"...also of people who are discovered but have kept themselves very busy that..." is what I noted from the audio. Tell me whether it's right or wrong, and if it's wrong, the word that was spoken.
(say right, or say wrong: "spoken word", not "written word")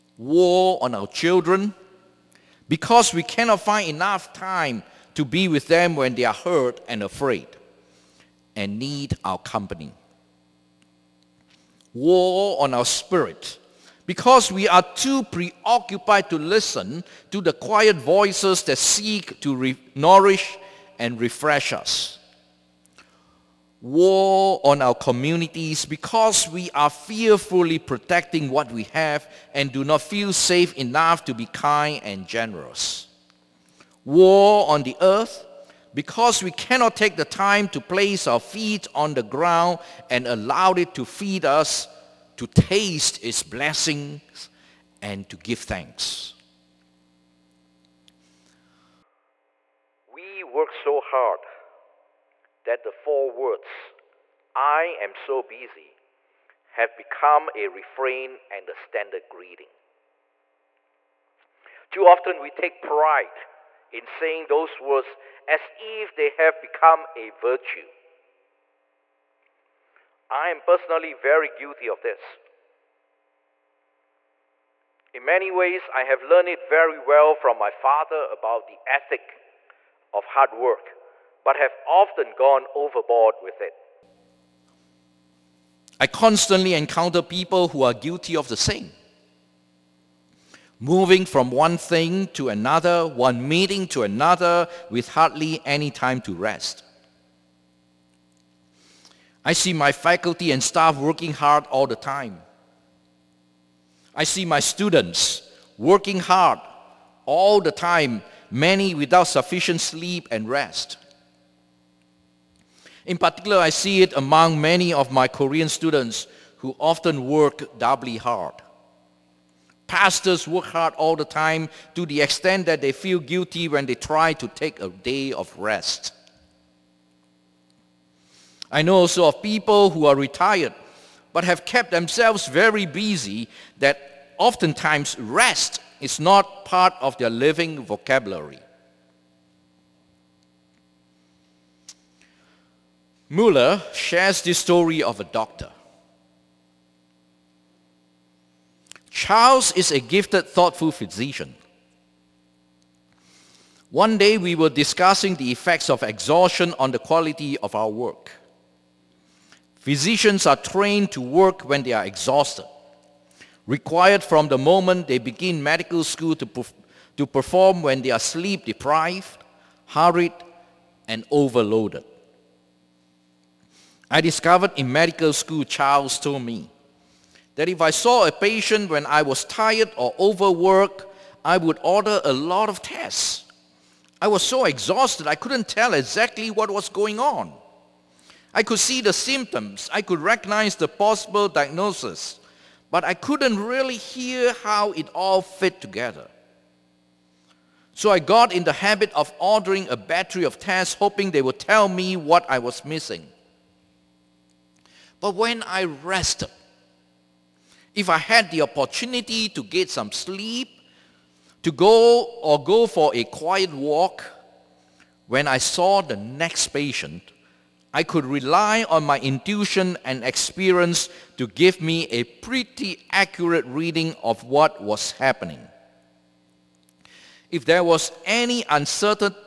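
wrong: "retired", not "discovered".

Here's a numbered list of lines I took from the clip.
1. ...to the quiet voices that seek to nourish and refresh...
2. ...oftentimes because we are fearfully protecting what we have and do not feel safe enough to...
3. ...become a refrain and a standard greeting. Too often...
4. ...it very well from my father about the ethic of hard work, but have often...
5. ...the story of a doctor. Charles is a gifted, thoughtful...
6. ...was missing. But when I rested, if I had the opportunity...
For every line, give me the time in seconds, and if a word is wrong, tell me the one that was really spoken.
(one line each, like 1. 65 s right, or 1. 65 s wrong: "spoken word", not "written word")
1. 17 s right
2. 24 s wrong: "communities", not "oftentimes"
3. 56 s right
4. 76 s right
5. 144 s right
6. 202 s right.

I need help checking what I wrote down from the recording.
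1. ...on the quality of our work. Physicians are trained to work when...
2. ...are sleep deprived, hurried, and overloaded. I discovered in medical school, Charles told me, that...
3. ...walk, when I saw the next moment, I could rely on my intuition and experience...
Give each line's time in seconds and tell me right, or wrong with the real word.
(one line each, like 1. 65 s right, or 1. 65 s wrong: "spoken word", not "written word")
1. 156 s right
2. 168 s right
3. 213 s wrong: "patient", not "moment".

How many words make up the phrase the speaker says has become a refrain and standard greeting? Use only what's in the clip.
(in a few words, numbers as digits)
4.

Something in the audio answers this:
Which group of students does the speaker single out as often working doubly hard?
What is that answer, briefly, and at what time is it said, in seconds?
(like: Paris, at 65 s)
Korean students, at 115 s.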